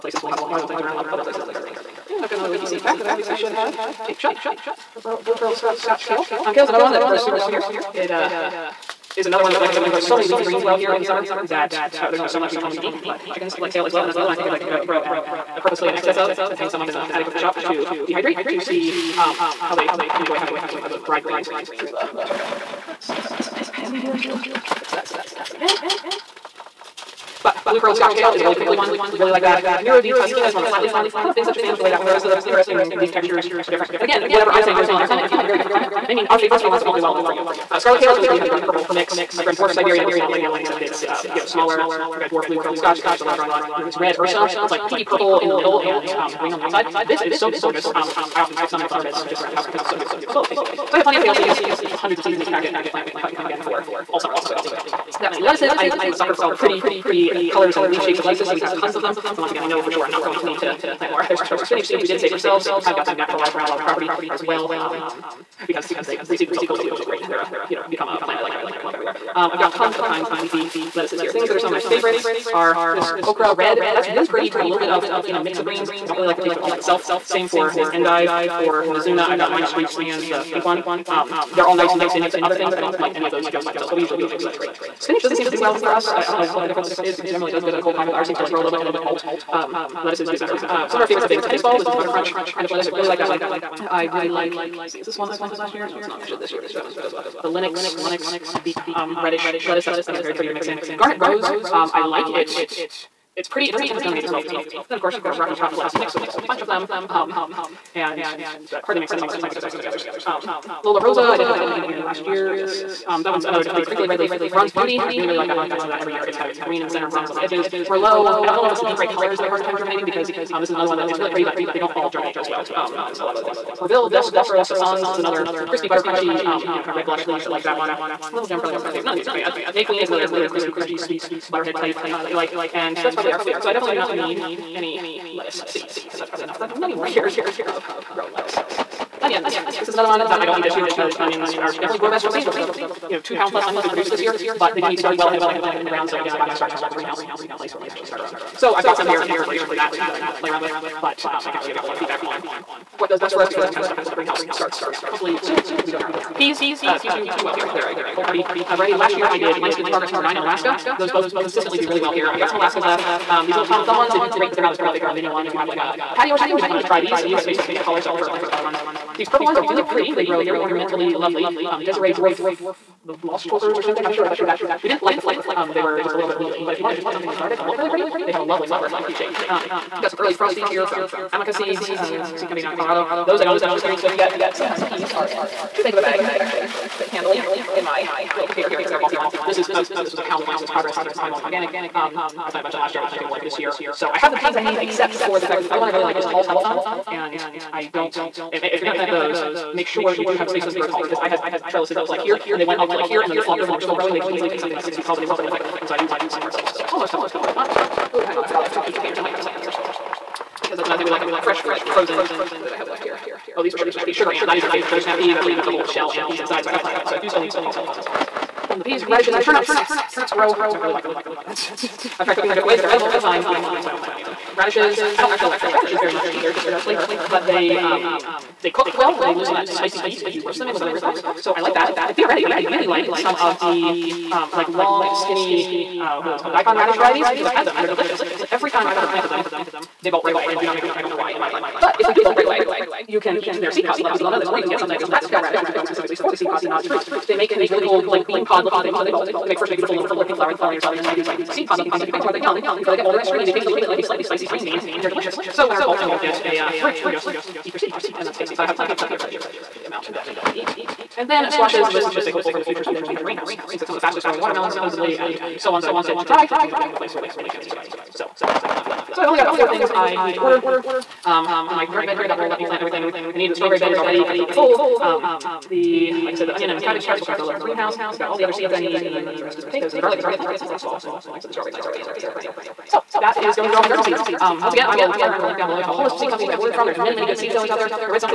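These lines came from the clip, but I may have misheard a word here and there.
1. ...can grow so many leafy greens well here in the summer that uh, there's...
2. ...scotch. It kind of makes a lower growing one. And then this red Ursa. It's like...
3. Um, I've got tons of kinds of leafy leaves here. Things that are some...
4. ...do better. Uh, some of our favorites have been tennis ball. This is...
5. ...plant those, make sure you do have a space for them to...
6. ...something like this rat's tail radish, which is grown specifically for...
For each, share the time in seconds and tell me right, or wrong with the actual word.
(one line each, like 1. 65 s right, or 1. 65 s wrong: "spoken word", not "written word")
1. 9 s right
2. 42 s right
3. 69 s wrong: "lettuces", not "leaves"
4. 90 s right
5. 198 s right
6. 244 s right.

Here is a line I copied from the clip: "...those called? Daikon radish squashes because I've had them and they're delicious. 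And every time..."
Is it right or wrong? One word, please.
wrong.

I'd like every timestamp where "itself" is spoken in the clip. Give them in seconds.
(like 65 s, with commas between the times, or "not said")
76 s.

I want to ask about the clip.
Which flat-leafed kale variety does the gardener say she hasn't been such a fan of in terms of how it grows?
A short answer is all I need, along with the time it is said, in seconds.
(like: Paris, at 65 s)
Nero di Toscana, at 29 s.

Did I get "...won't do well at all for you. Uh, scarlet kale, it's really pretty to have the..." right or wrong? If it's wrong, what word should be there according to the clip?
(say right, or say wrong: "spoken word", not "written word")
right.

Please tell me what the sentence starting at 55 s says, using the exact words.
I am a sucker for all the pretty pretty uh, colors and leaf shapes of lettuces, so we have tons of them.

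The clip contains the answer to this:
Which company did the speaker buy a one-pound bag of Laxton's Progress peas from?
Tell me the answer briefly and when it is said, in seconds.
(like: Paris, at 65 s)
High Mowing Organic, at 191 s.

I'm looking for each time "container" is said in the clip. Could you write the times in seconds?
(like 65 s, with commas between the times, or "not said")
188 s, 208 s.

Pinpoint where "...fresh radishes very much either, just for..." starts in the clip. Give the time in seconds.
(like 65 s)
225 s.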